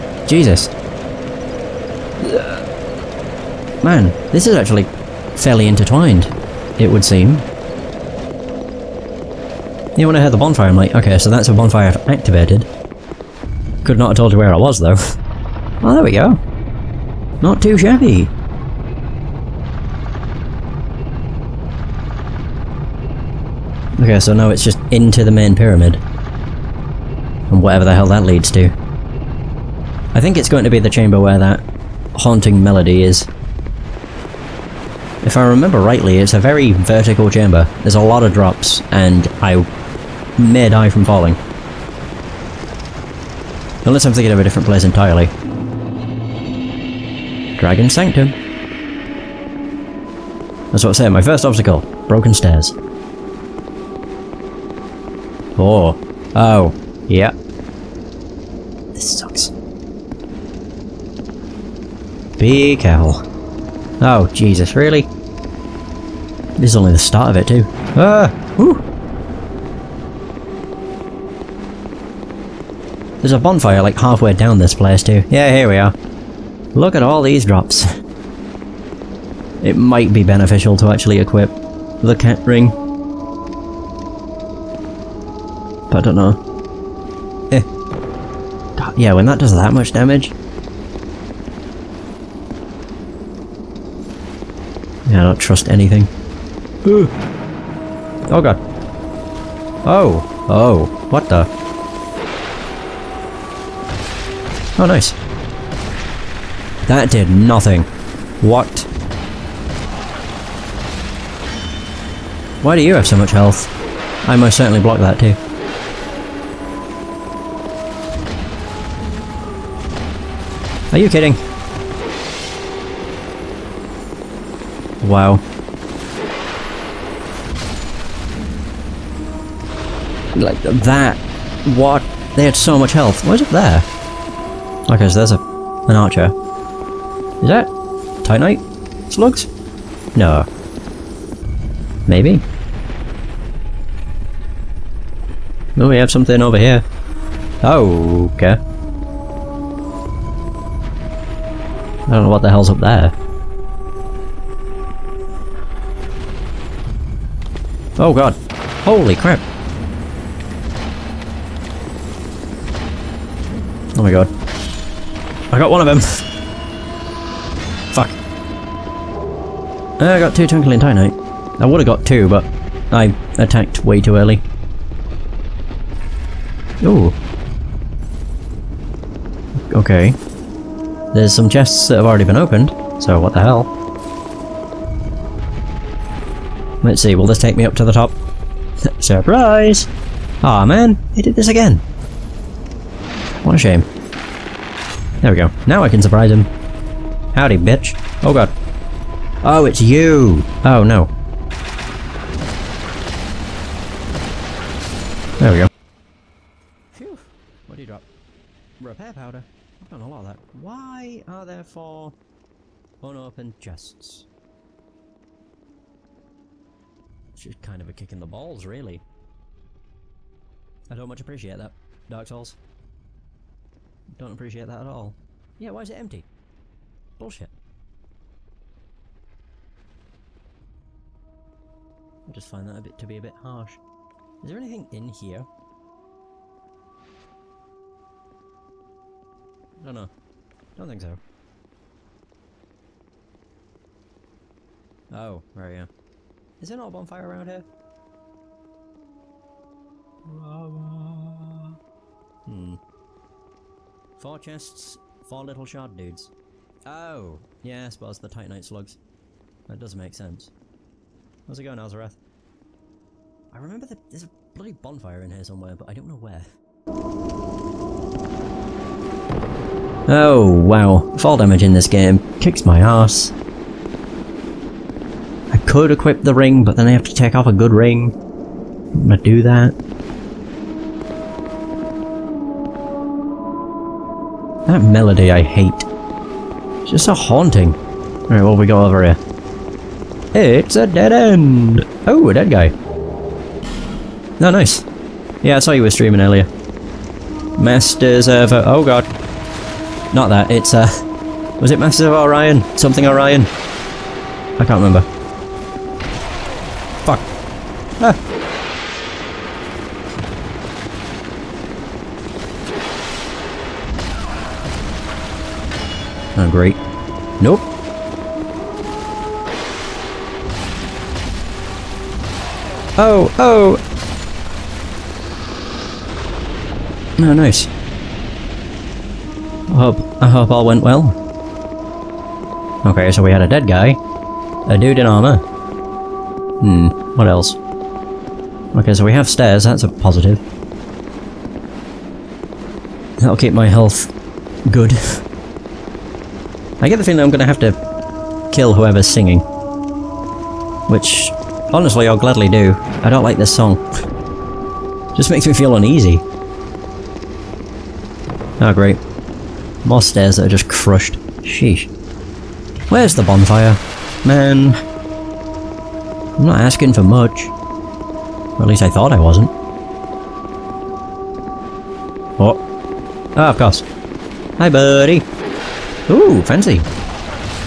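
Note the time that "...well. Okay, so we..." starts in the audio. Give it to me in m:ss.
5:30.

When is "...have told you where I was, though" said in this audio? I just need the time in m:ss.
0:14.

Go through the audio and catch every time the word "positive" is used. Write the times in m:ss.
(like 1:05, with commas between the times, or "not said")
5:39.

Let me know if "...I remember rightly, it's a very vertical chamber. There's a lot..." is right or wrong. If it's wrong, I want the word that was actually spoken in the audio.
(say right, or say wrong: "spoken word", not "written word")
right.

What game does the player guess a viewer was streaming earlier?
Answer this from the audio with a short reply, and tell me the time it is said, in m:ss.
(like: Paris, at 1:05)
Masters of Orion, at 5:01.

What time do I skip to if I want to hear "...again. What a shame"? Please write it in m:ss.
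3:11.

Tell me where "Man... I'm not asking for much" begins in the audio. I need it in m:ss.
6:04.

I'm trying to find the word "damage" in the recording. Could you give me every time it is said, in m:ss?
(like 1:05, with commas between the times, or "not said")
1:29, 4:31.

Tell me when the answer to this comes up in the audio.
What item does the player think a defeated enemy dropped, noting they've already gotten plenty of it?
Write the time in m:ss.
3:28.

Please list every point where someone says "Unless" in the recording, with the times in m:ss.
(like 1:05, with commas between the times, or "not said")
0:43.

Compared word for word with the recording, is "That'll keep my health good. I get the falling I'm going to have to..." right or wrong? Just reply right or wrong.
wrong.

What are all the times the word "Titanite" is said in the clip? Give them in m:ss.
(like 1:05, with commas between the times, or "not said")
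2:18, 4:18.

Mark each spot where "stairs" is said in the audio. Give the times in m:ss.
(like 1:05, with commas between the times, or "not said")
0:52, 5:39, 6:00.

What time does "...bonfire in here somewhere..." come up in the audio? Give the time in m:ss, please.
4:24.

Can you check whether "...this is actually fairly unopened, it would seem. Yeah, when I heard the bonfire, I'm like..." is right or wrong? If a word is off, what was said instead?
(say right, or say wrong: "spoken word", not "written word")
wrong: "intertwined", not "unopened".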